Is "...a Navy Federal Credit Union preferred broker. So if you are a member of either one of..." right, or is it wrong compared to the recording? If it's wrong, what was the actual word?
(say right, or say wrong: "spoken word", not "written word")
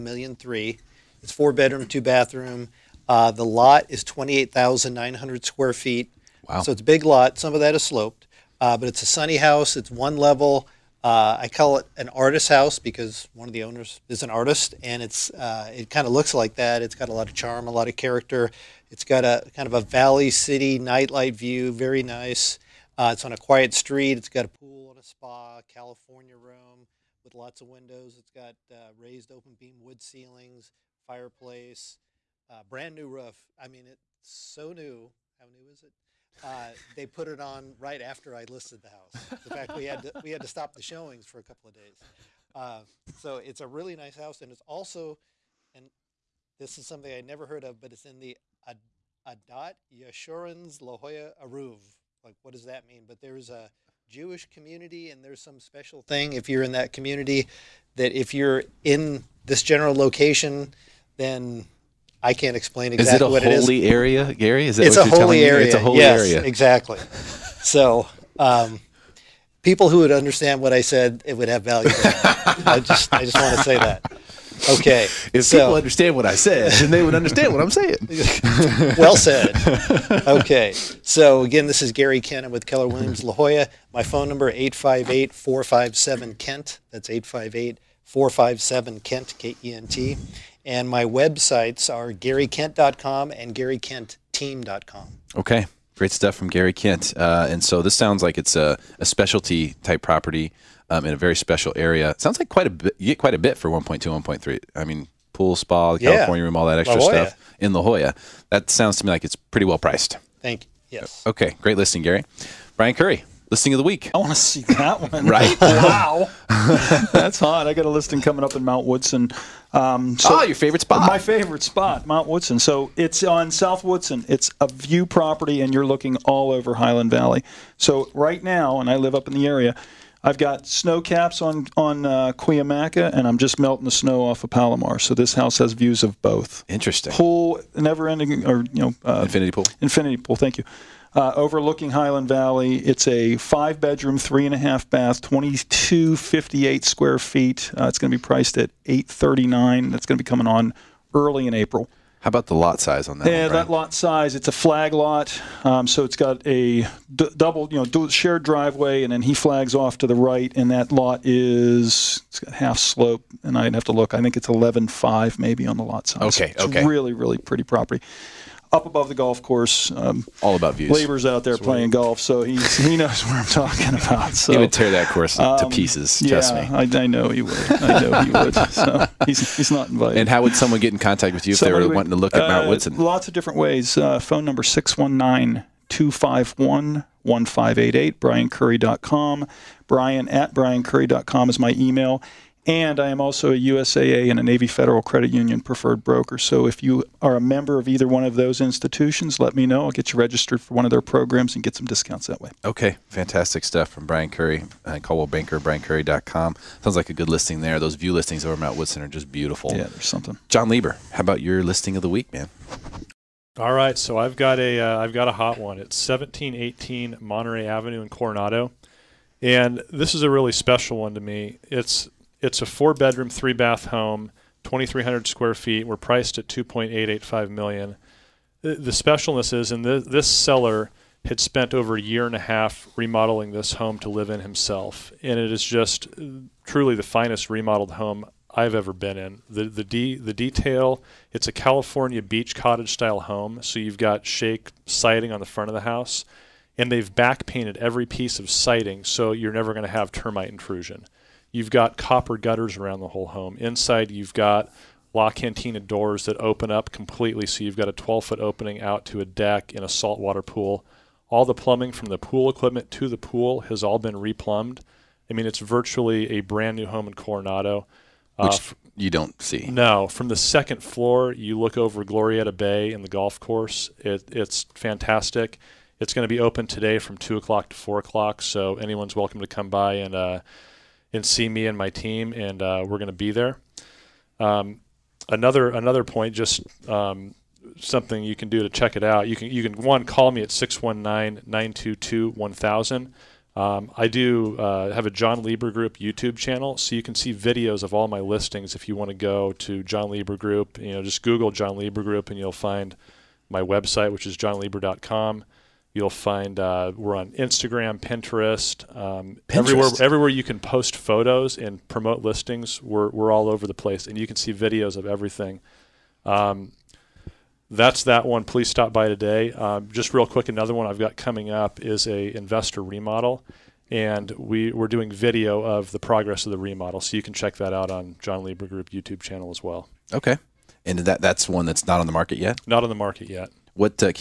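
right.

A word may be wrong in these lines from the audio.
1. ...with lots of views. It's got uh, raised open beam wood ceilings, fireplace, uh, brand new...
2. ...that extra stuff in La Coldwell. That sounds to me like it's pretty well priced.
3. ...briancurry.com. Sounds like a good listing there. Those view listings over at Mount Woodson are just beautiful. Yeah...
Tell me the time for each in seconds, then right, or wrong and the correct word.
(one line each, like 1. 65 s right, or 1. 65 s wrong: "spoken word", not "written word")
1. 27 s wrong: "windows", not "views"
2. 106 s wrong: "Jolla", not "Coldwell"
3. 205 s right.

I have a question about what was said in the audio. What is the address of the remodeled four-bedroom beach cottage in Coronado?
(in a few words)
1718 Monterey Avenue.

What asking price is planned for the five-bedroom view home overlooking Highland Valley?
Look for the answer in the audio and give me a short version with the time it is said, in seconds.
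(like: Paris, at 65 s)
839, at 148 s.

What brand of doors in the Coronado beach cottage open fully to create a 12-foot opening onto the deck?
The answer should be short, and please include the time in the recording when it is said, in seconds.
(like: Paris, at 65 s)
La Cantina, at 255 s.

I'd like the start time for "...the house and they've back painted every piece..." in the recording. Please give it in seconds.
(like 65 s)
245 s.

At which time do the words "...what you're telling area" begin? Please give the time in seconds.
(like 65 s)
64 s.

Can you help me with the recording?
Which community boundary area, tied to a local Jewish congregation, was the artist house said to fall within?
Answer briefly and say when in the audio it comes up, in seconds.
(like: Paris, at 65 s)
Adat Yeshurun's La Jolla Eruv, at 48 s.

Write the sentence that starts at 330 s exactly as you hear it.
Okay, and that that's one that's not on the market yet.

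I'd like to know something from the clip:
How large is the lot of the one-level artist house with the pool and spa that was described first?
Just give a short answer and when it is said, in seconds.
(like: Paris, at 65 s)
28,900 square feet, at 4 s.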